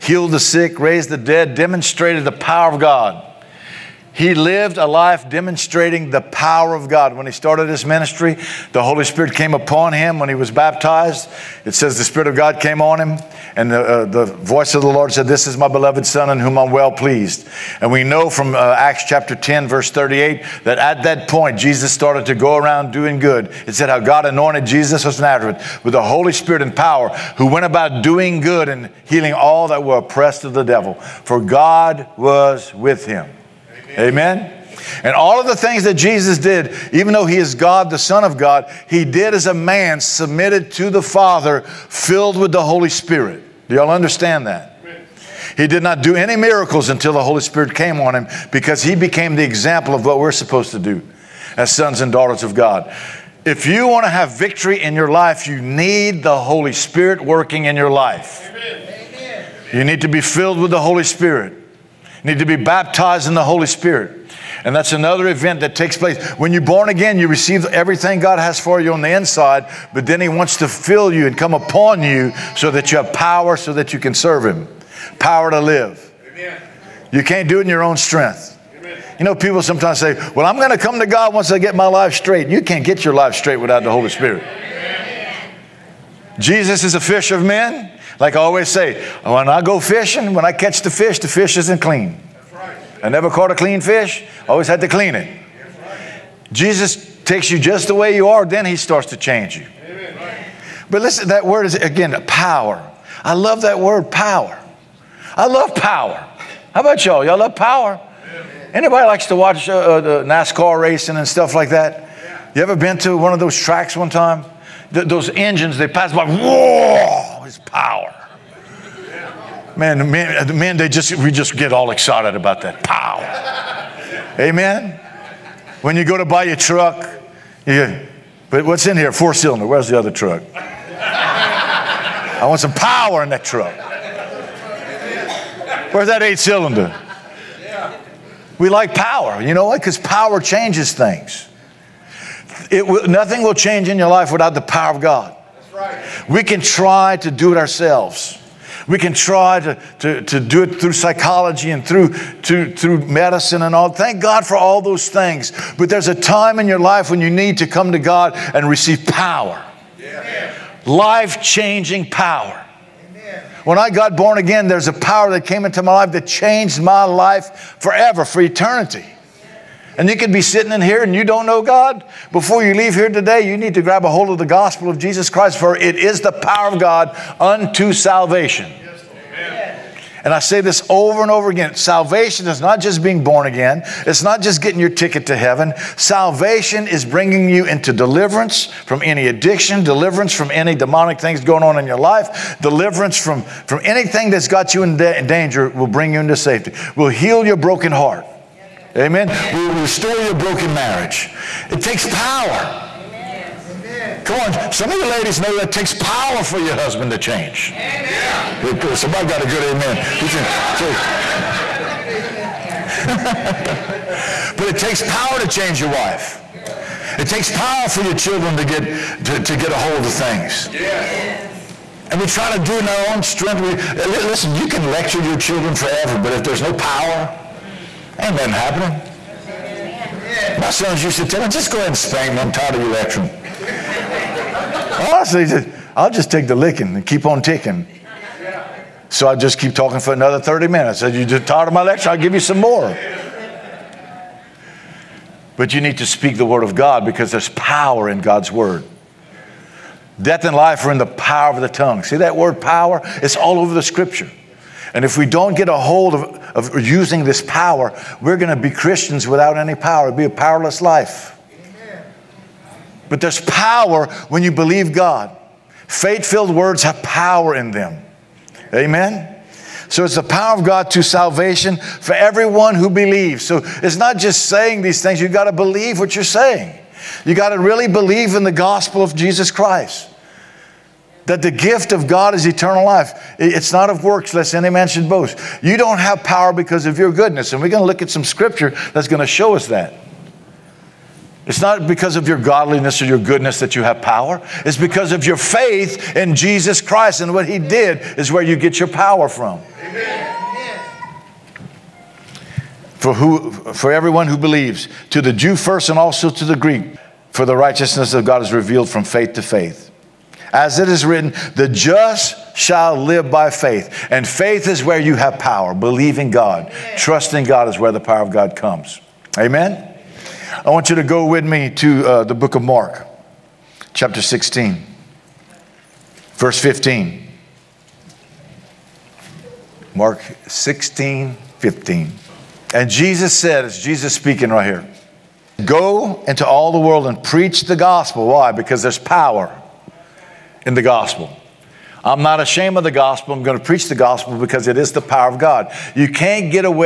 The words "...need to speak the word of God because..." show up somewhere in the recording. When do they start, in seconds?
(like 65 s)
245 s.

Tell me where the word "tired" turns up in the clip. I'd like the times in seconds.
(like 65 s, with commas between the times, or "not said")
232 s, 241 s.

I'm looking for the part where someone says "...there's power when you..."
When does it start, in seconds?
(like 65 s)
263 s.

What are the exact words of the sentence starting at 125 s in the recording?
When you go to buy your truck, you, but what's in here?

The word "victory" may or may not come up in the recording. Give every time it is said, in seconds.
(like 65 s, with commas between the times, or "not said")
54 s.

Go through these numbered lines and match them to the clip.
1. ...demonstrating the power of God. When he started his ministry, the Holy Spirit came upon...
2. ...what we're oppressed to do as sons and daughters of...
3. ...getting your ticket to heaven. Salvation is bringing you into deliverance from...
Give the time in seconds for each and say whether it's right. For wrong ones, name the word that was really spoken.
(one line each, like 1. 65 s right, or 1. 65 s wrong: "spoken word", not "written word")
1. 5 s right
2. 50 s wrong: "supposed", not "oppressed"
3. 184 s right.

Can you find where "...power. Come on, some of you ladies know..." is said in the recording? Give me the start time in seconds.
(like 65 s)
202 s.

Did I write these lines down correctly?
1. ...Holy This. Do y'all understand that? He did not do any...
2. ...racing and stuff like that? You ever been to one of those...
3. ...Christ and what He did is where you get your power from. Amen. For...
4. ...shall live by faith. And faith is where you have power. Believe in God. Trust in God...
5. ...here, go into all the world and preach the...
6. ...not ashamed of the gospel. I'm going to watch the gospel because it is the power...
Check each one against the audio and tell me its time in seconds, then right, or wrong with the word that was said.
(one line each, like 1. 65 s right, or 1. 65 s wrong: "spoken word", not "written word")
1. 42 s wrong: "Spirit", not "This"
2. 110 s right
3. 296 s right
4. 312 s right
5. 334 s right
6. 342 s wrong: "preach", not "watch".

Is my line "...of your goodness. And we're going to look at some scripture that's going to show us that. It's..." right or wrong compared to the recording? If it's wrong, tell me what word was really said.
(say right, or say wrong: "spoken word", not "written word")
right.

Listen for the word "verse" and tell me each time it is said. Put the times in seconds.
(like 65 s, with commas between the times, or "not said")
19 s, 326 s.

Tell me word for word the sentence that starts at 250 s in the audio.
Death and life are in the power of the tongue.